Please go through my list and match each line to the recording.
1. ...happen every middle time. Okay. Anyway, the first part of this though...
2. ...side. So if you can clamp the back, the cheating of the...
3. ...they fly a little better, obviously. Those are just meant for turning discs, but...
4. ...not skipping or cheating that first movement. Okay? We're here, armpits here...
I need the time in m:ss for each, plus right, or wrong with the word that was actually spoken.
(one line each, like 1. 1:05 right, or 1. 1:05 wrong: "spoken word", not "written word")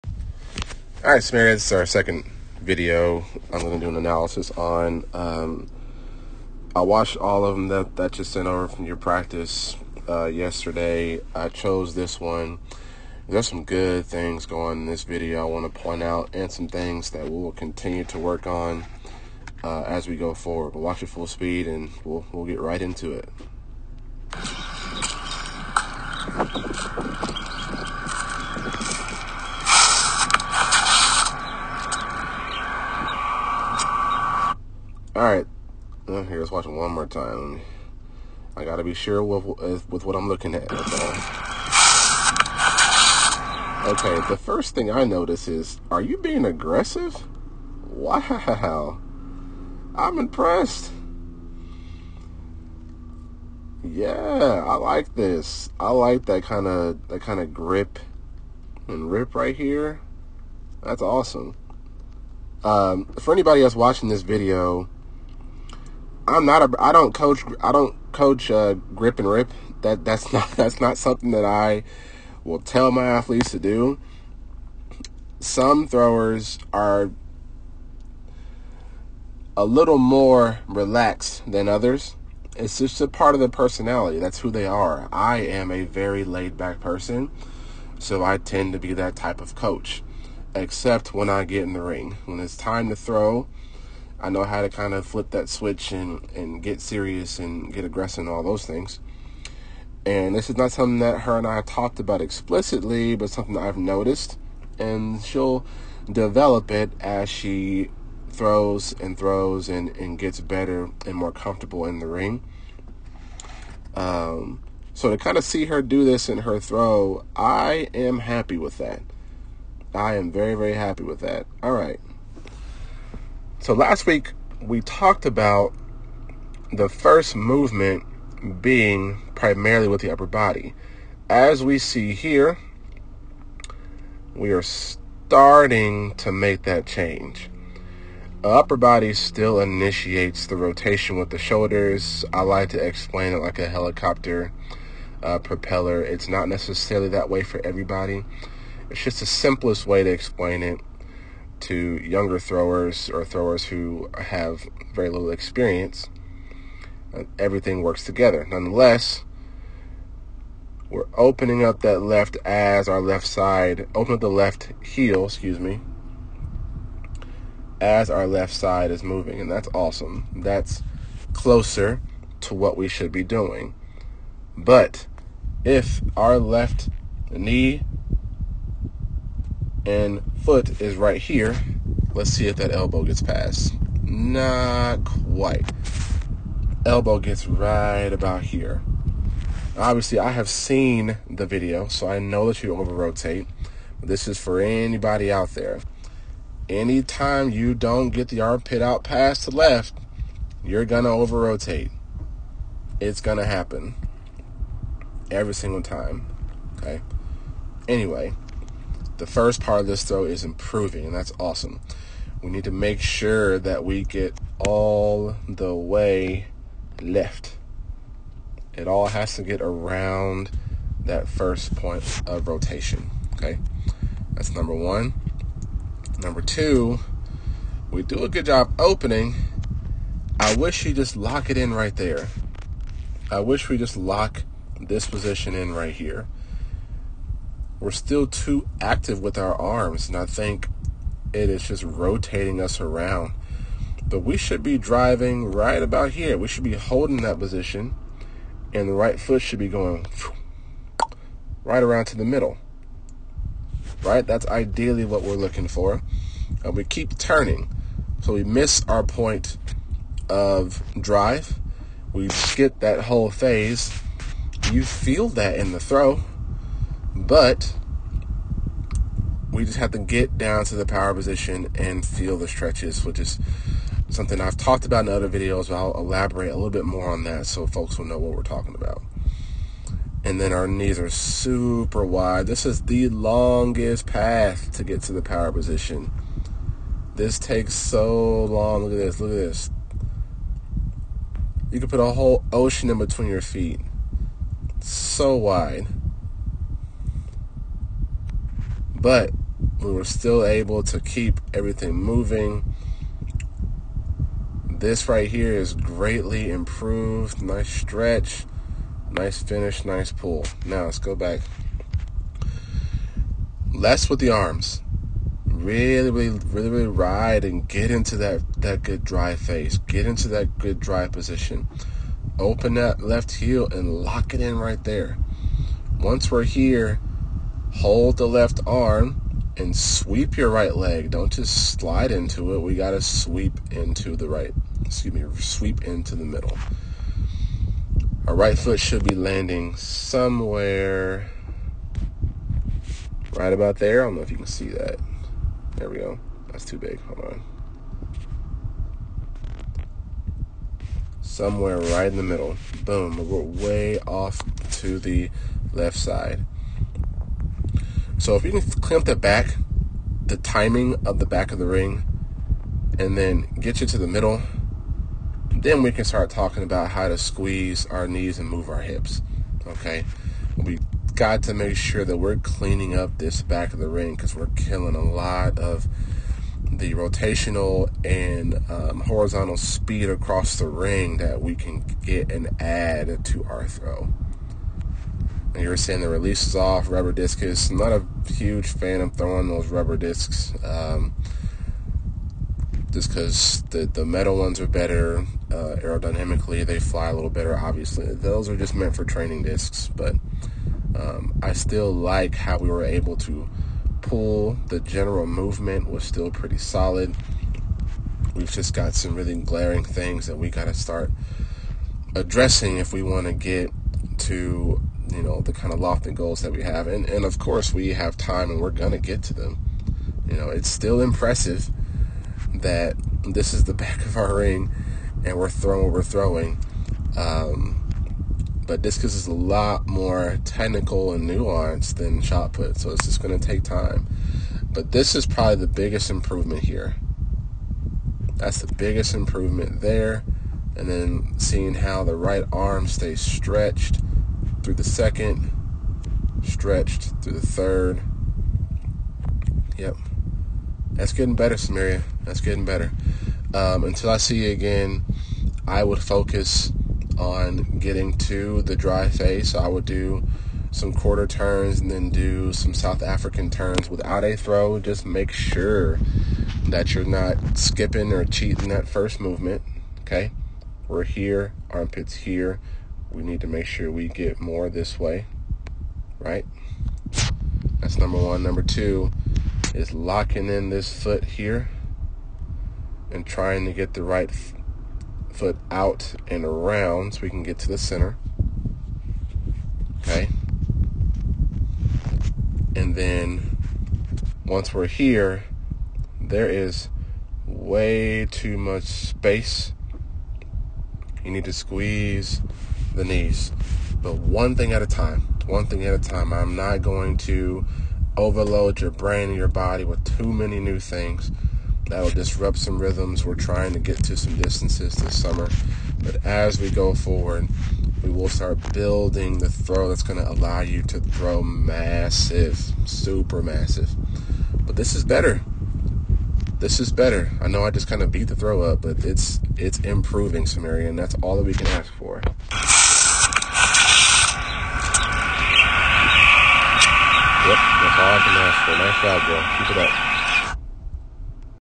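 1. 3:23 wrong: "single", not "middle"
2. 5:55 wrong: "timing", not "cheating"
3. 6:36 wrong: "training", not "turning"
4. 7:47 right.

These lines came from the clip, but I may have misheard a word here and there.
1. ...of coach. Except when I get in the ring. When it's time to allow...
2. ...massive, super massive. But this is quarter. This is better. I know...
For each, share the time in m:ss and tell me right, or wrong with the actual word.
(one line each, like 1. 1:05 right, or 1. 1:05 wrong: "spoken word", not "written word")
1. 1:29 wrong: "throw", not "allow"
2. 8:41 wrong: "better", not "quarter".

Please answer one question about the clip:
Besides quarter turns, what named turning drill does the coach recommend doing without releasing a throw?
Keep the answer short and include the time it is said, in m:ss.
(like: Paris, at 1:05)
South African turns, at 7:42.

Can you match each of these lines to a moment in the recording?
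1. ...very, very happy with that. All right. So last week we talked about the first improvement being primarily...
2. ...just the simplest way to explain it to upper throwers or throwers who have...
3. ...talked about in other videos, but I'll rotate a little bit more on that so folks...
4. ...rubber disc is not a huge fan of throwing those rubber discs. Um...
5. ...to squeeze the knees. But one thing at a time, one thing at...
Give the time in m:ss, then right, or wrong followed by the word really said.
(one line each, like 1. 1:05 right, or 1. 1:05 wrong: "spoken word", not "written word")
1. 2:00 wrong: "movement", not "improvement"
2. 2:29 wrong: "younger", not "upper"
3. 4:34 wrong: "elaborate", not "rotate"
4. 6:26 right
5. 8:21 right.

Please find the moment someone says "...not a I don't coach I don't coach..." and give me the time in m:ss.
1:06.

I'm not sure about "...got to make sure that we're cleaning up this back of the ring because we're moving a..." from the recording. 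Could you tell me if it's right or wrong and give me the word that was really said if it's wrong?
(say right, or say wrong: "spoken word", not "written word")
wrong: "killing", not "moving".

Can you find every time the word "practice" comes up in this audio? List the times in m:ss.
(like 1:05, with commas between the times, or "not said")
0:08.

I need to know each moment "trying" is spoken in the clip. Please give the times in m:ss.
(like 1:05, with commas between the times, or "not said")
8:03, 8:33.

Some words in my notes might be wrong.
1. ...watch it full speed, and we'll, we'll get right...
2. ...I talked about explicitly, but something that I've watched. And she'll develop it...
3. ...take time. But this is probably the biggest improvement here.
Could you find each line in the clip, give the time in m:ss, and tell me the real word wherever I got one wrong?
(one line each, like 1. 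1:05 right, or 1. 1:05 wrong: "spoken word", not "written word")
1. 0:20 right
2. 1:41 wrong: "noticed", not "watched"
3. 7:13 right.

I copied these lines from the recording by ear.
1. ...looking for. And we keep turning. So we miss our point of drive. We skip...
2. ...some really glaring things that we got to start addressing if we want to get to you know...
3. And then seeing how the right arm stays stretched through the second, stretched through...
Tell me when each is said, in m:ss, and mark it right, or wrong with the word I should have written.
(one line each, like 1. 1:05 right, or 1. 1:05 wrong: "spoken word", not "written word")
1. 4:15 right
2. 6:48 right
3. 7:20 right.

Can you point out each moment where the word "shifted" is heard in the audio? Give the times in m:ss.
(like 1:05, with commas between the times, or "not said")
not said.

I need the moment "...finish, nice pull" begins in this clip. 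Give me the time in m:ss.
5:09.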